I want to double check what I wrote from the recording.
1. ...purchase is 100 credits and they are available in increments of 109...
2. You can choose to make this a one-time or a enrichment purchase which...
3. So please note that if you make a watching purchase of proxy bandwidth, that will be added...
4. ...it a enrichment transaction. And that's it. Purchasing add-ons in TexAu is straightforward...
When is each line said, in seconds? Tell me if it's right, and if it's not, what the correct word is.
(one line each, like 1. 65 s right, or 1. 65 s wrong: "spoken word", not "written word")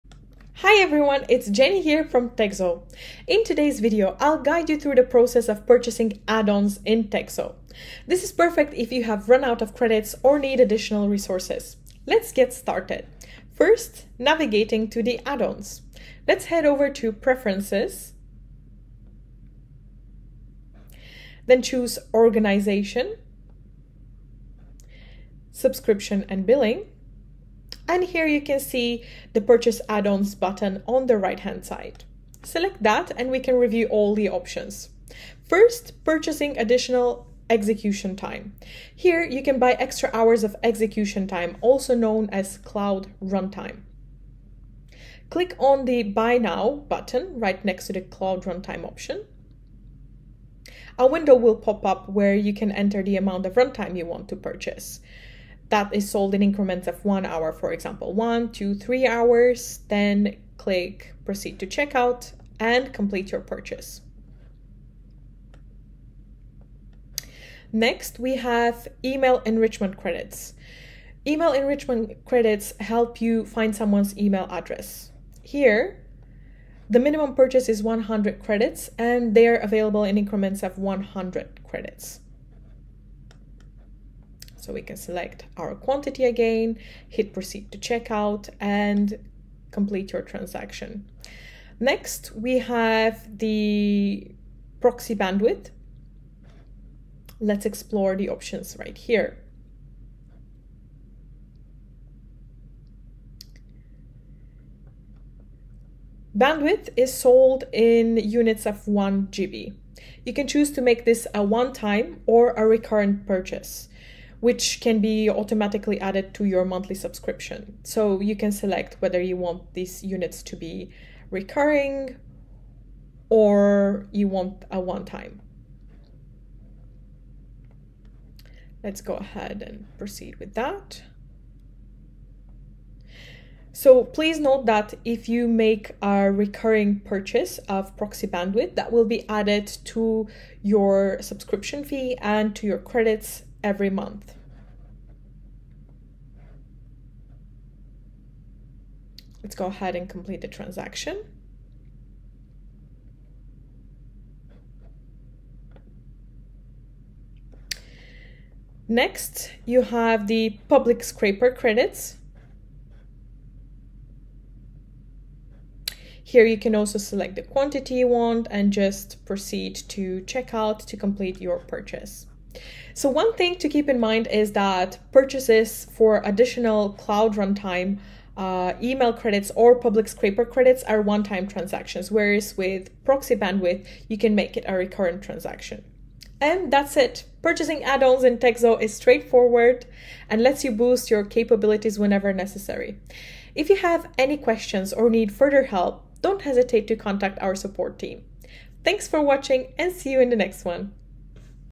1. 77 s wrong: "100", not "109"
2. 110 s wrong: "recurrent", not "enrichment"
3. 133 s wrong: "recurring", not "watching"
4. 184 s wrong: "recurrent", not "enrichment".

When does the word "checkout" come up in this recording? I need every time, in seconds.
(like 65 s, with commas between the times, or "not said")
61 s, 87 s, 170 s.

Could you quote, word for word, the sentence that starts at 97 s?
Let's explore the options right here.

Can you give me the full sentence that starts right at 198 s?
Thanks for watching and see you in the next one.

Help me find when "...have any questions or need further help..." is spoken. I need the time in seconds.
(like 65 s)
193 s.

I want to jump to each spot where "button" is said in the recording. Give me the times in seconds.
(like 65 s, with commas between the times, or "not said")
30 s, 46 s.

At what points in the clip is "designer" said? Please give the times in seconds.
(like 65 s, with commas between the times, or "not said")
not said.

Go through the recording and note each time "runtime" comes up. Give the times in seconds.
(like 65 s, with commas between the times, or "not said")
43 s, 48 s, 53 s, 177 s.